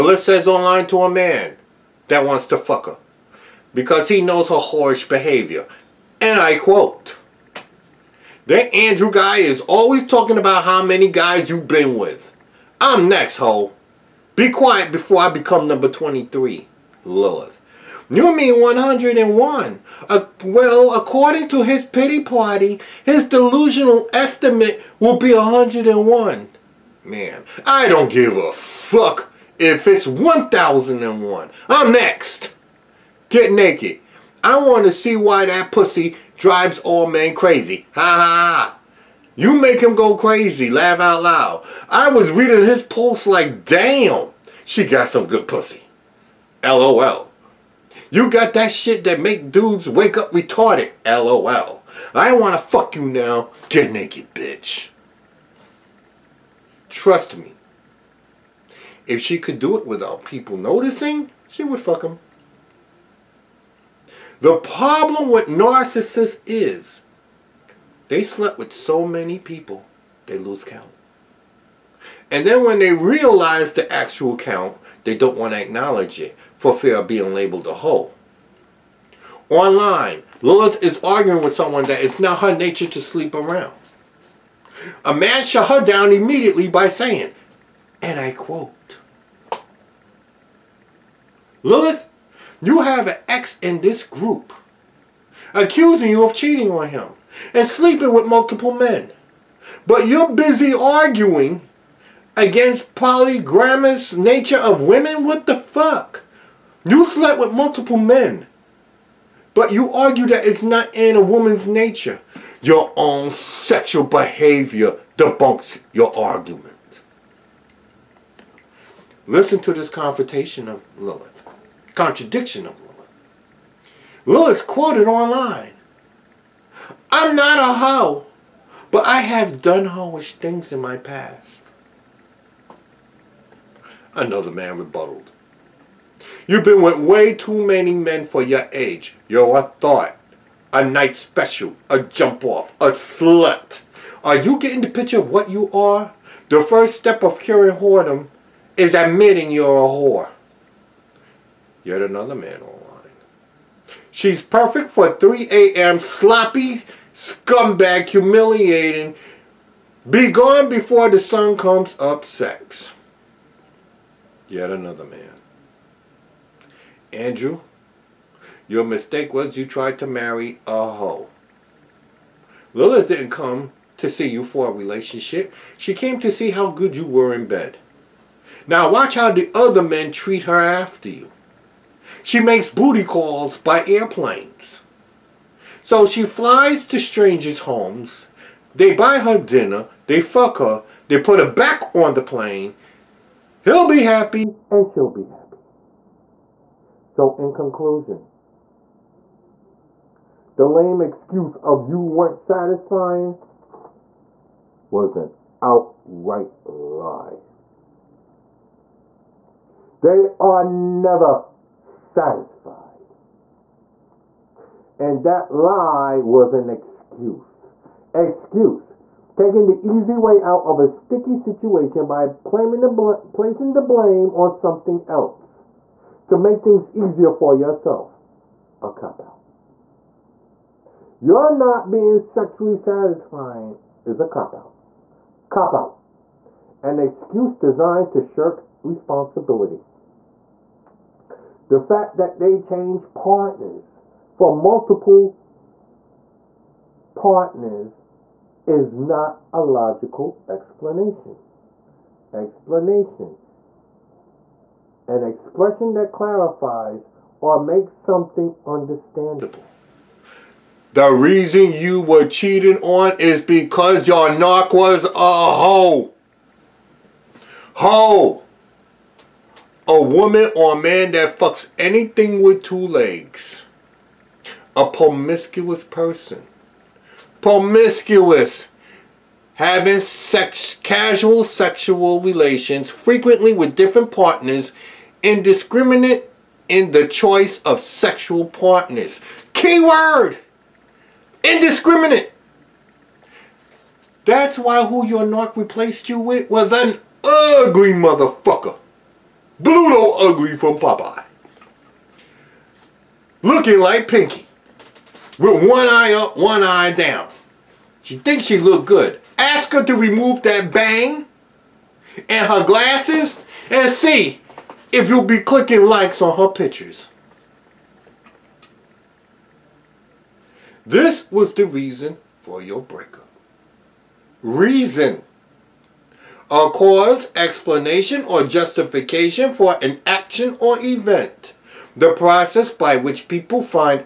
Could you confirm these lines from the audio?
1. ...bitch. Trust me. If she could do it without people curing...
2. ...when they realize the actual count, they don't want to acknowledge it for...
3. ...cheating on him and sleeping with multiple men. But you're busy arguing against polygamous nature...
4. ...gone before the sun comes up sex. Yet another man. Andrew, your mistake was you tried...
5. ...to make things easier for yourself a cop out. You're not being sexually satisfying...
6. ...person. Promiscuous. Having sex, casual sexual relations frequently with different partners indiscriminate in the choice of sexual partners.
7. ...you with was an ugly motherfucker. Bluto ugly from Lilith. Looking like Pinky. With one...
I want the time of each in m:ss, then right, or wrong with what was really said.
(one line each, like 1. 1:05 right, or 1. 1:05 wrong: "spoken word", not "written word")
1. 0:54 wrong: "noticing", not "curing"
2. 1:12 right
3. 1:36 right
4. 2:40 right
5. 3:46 right
6. 4:35 right
7. 4:56 wrong: "Popeye", not "Lilith".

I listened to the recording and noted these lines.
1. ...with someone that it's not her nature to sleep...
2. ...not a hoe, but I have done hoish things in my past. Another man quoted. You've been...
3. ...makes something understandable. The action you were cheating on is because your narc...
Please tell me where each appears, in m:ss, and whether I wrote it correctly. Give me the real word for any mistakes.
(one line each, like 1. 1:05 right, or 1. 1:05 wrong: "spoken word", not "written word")
1. 1:21 right
2. 2:07 wrong: "rebutted", not "quoted"
3. 4:17 wrong: "reason", not "action".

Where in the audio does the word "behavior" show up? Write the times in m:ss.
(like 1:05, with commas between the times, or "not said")
0:05, 1:54.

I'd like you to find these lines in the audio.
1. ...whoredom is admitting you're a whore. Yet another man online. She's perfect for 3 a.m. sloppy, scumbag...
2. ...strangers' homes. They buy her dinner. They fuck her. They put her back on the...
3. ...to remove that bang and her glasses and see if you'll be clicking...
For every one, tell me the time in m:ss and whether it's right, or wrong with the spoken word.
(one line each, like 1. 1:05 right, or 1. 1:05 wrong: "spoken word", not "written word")
1. 2:27 right
2. 3:06 right
3. 5:09 right.